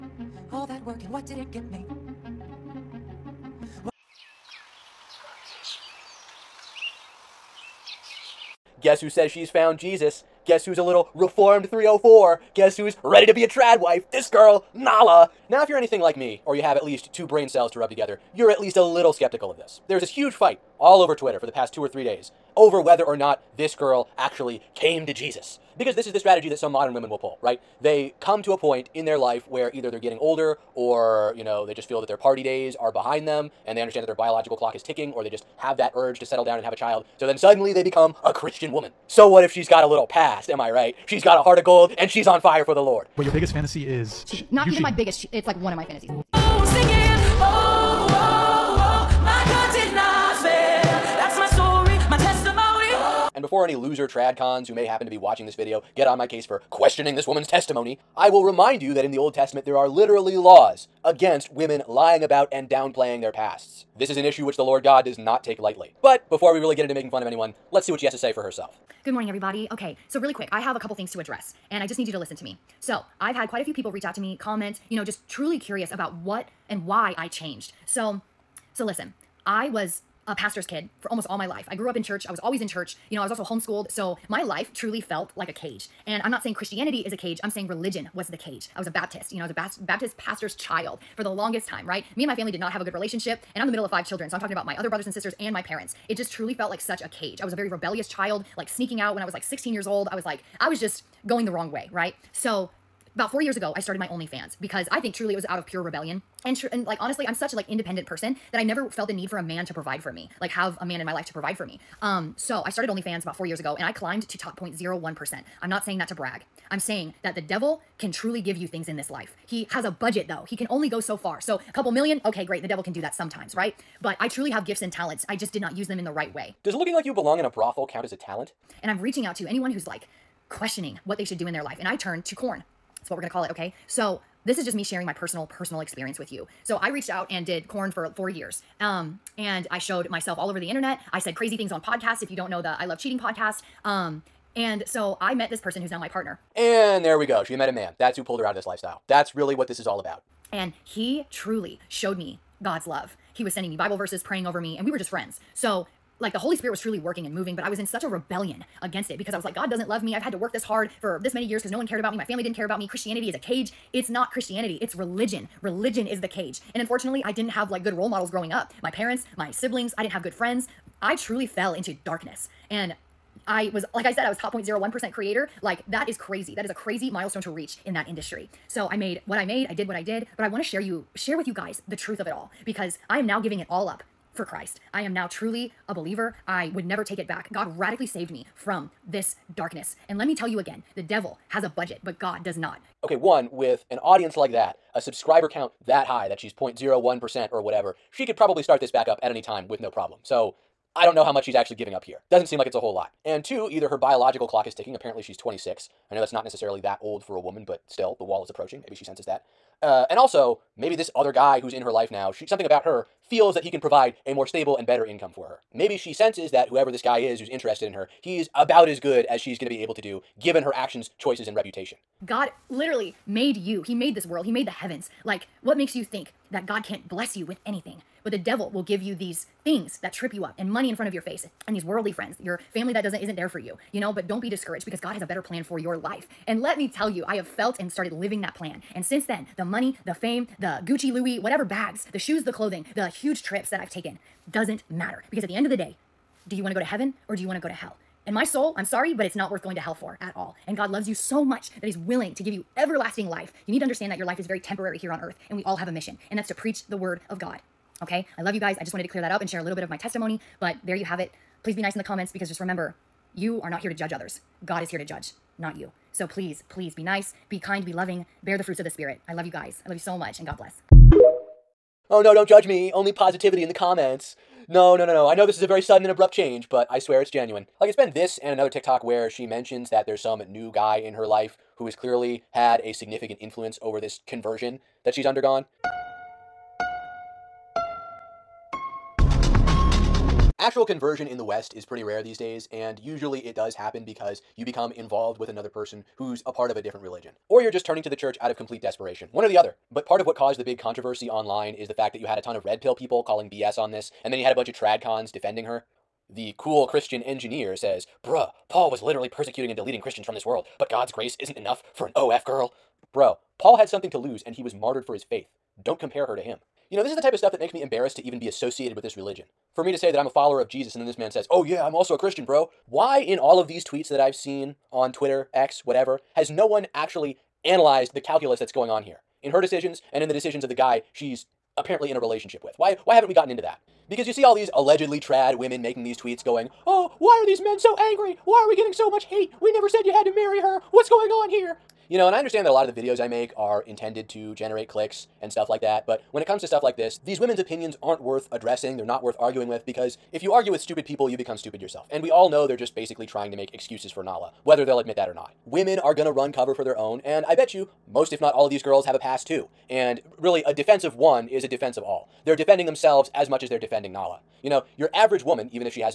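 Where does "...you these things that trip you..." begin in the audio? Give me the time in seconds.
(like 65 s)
229 s.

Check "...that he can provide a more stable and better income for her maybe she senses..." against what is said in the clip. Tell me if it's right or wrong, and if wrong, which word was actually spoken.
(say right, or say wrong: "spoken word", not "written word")
right.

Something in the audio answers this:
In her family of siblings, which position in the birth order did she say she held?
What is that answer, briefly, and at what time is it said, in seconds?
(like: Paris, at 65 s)
middle of five children, at 93 s.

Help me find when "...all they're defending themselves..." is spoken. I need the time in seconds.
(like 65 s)
362 s.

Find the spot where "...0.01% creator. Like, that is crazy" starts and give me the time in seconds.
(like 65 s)
174 s.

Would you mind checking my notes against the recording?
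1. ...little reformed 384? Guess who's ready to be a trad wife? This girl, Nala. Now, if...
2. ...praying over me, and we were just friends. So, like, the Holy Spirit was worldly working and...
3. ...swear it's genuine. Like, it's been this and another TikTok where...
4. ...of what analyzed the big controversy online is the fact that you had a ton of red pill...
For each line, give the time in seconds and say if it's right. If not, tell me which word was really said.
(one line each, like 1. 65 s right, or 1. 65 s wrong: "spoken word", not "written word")
1. 10 s wrong: "304", not "384"
2. 154 s wrong: "truly", not "worldly"
3. 276 s right
4. 300 s wrong: "caused", not "analyzed".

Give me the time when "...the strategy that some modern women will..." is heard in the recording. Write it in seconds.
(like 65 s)
26 s.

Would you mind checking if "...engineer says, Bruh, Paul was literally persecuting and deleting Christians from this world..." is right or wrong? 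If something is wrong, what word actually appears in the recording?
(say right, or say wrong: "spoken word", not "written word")
right.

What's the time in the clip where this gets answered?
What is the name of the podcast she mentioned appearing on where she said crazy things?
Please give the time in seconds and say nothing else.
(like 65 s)
142 s.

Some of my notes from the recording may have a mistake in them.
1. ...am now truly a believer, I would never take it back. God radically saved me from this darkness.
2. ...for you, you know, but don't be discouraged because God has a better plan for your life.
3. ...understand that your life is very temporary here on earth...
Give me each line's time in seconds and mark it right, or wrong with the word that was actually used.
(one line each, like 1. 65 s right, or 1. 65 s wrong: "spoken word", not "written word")
1. 184 s right
2. 233 s right
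3. 253 s right.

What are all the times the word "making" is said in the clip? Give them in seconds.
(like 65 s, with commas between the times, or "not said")
66 s, 335 s.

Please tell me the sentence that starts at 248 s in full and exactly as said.
And my soul, I'm sorry, but it's not worth going to hell for at all.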